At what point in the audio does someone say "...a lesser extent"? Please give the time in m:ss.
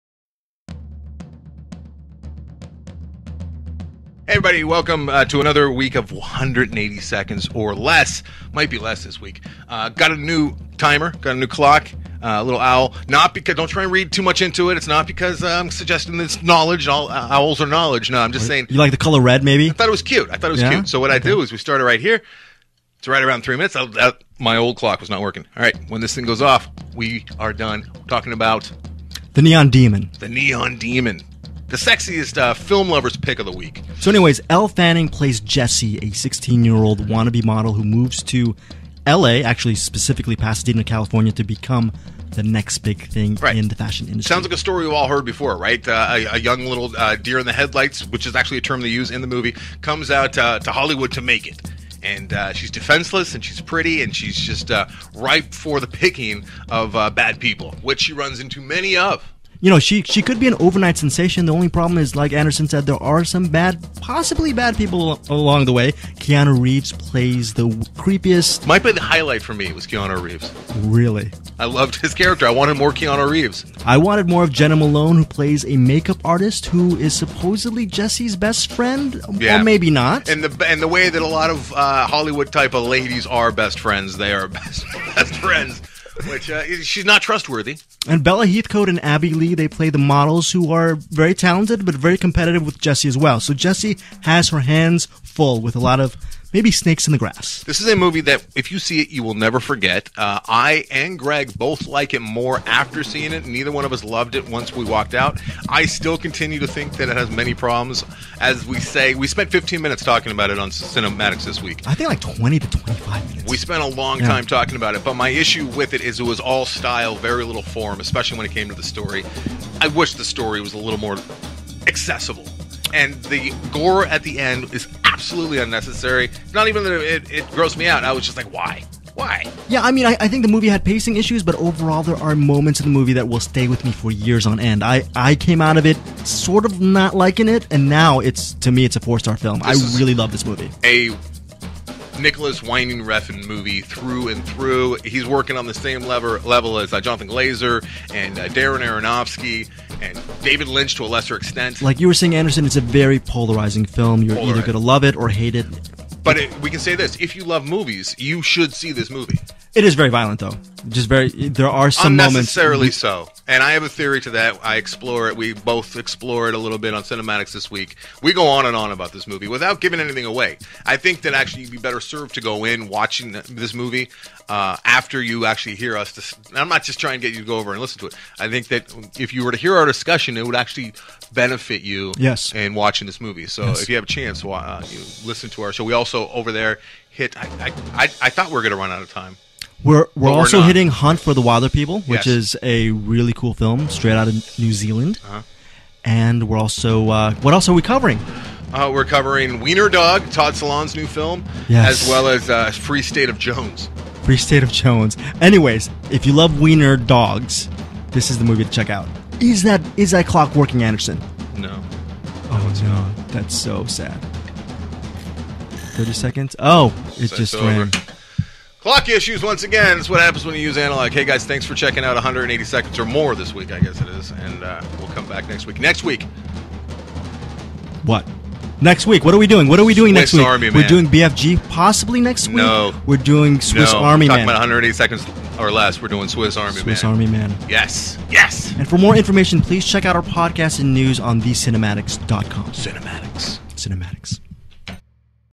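2:31.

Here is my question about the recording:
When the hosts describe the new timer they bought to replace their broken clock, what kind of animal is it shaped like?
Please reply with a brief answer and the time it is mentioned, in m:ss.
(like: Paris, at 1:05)
owl, at 0:12.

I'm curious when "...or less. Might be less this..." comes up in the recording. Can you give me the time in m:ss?
0:07.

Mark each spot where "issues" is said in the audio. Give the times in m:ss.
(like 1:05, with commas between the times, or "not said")
1:55, 2:11, 3:39.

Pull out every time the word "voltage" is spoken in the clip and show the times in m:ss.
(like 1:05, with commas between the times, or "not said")
not said.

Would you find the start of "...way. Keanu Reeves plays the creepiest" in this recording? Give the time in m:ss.
1:05.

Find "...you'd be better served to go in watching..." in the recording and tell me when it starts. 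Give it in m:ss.
2:51.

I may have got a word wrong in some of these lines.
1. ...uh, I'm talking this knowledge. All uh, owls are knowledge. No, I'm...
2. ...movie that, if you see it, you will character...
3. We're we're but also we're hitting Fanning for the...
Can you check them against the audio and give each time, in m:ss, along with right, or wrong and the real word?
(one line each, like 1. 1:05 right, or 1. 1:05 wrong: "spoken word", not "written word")
1. 0:15 wrong: "suggesting", not "talking"
2. 1:37 wrong: "never", not "character"
3. 3:09 wrong: "Hunt", not "Fanning".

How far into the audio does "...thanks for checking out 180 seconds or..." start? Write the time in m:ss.
3:41.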